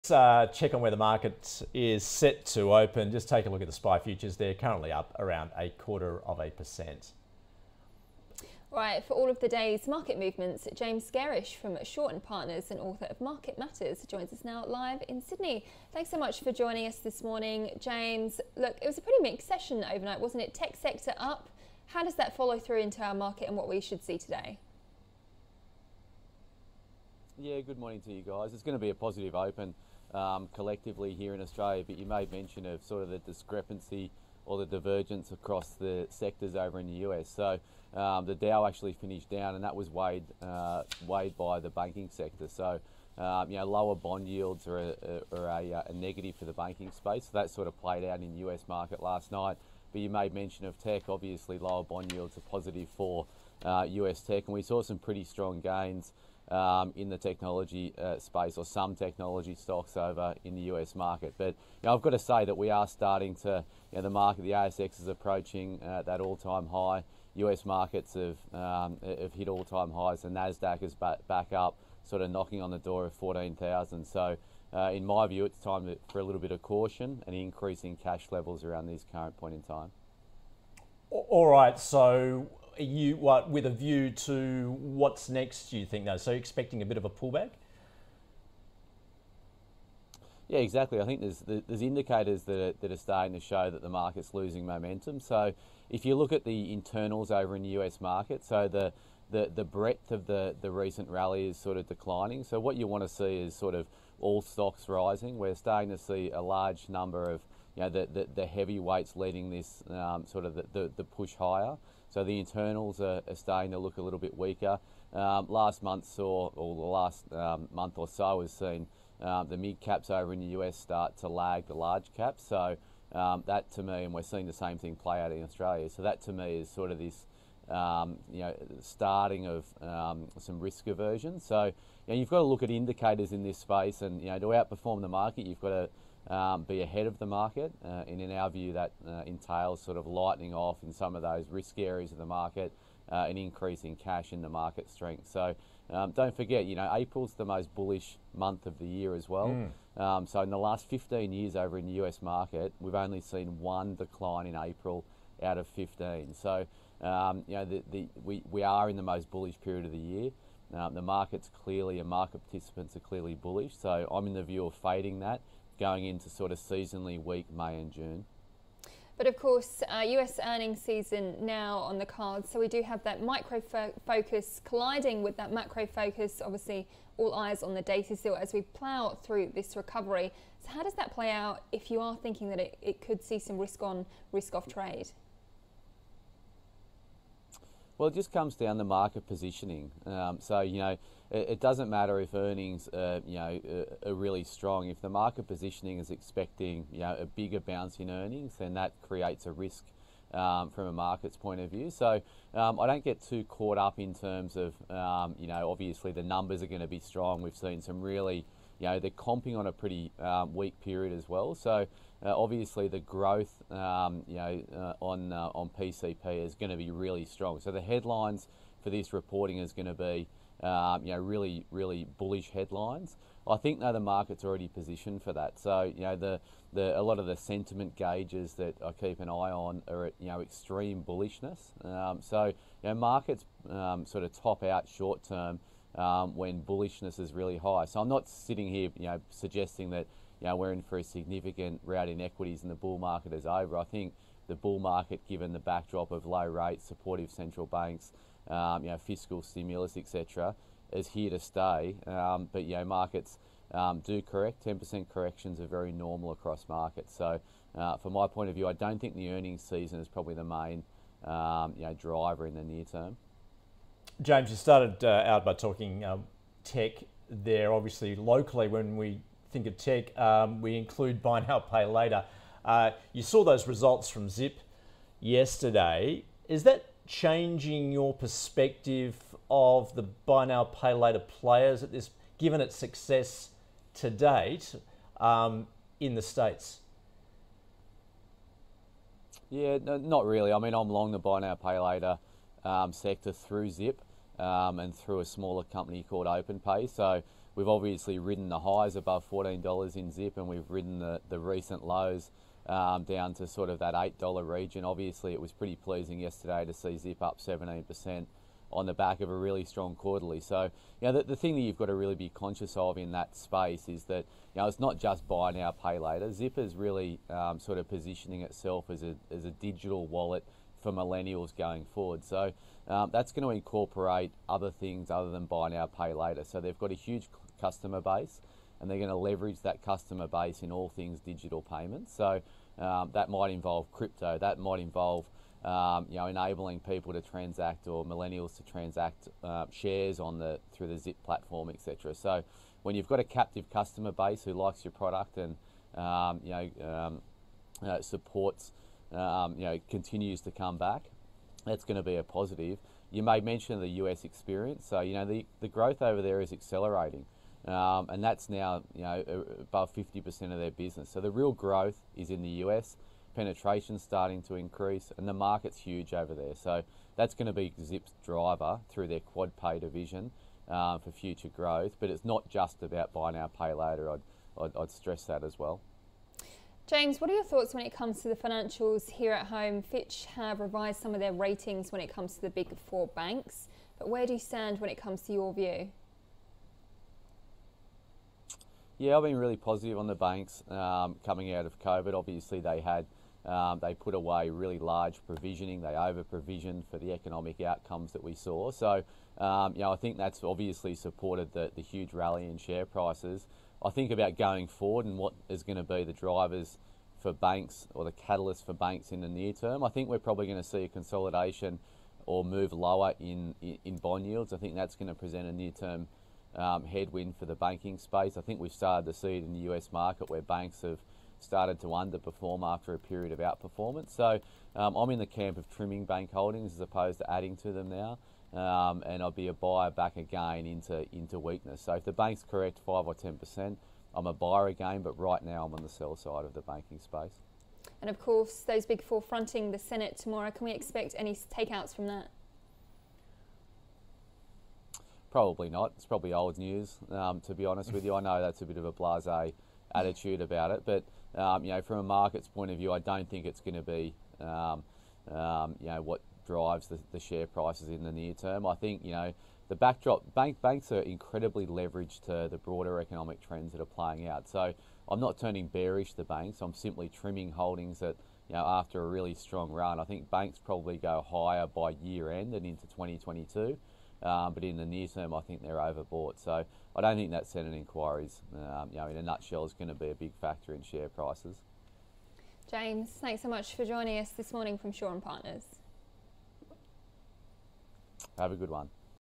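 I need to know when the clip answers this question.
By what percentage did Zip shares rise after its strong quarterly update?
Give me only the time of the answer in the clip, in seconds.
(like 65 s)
307 s.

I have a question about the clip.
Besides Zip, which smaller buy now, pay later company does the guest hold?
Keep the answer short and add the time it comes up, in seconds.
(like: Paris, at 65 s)
OpenPay, at 296 s.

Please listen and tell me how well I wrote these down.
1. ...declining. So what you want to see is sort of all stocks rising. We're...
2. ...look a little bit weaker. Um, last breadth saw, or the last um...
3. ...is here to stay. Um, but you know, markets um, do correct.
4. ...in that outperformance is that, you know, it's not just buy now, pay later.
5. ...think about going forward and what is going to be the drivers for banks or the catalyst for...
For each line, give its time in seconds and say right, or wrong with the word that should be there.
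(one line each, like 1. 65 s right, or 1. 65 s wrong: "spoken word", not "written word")
1. 101 s right
2. 113 s wrong: "month", not "breadth"
3. 250 s right
4. 312 s wrong: "space", not "outperformance"
5. 403 s right.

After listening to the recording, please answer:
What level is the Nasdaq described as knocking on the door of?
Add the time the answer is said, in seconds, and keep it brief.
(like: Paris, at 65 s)
14,000, at 73 s.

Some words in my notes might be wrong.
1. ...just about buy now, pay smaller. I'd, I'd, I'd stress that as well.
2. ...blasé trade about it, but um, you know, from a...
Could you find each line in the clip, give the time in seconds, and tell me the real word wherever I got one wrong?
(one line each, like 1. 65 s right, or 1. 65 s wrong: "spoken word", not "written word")
1. 372 s wrong: "later", not "smaller"
2. 448 s wrong: "attitude", not "trade".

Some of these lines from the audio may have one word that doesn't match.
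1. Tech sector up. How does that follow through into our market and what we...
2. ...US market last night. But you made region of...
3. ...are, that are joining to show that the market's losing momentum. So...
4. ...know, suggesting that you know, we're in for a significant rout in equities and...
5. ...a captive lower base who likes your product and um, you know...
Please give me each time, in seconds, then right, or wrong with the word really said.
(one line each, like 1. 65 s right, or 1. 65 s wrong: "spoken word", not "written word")
1. 20 s right
2. 48 s wrong: "mention", not "region"
3. 92 s wrong: "starting", not "joining"
4. 239 s right
5. 343 s wrong: "customer", not "lower".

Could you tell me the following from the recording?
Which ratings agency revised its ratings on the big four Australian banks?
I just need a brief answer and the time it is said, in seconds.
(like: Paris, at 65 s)
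Fitch, at 379 s.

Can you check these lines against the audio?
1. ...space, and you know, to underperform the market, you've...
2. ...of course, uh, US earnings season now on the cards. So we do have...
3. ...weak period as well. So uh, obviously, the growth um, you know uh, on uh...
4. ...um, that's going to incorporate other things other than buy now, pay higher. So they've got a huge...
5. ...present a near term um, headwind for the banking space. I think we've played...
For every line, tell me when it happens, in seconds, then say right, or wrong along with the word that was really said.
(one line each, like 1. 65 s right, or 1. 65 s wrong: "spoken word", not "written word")
1. 133 s wrong: "outperform", not "underperform"
2. 169 s right
3. 210 s right
4. 322 s wrong: "later", not "higher"
5. 415 s wrong: "started", not "played".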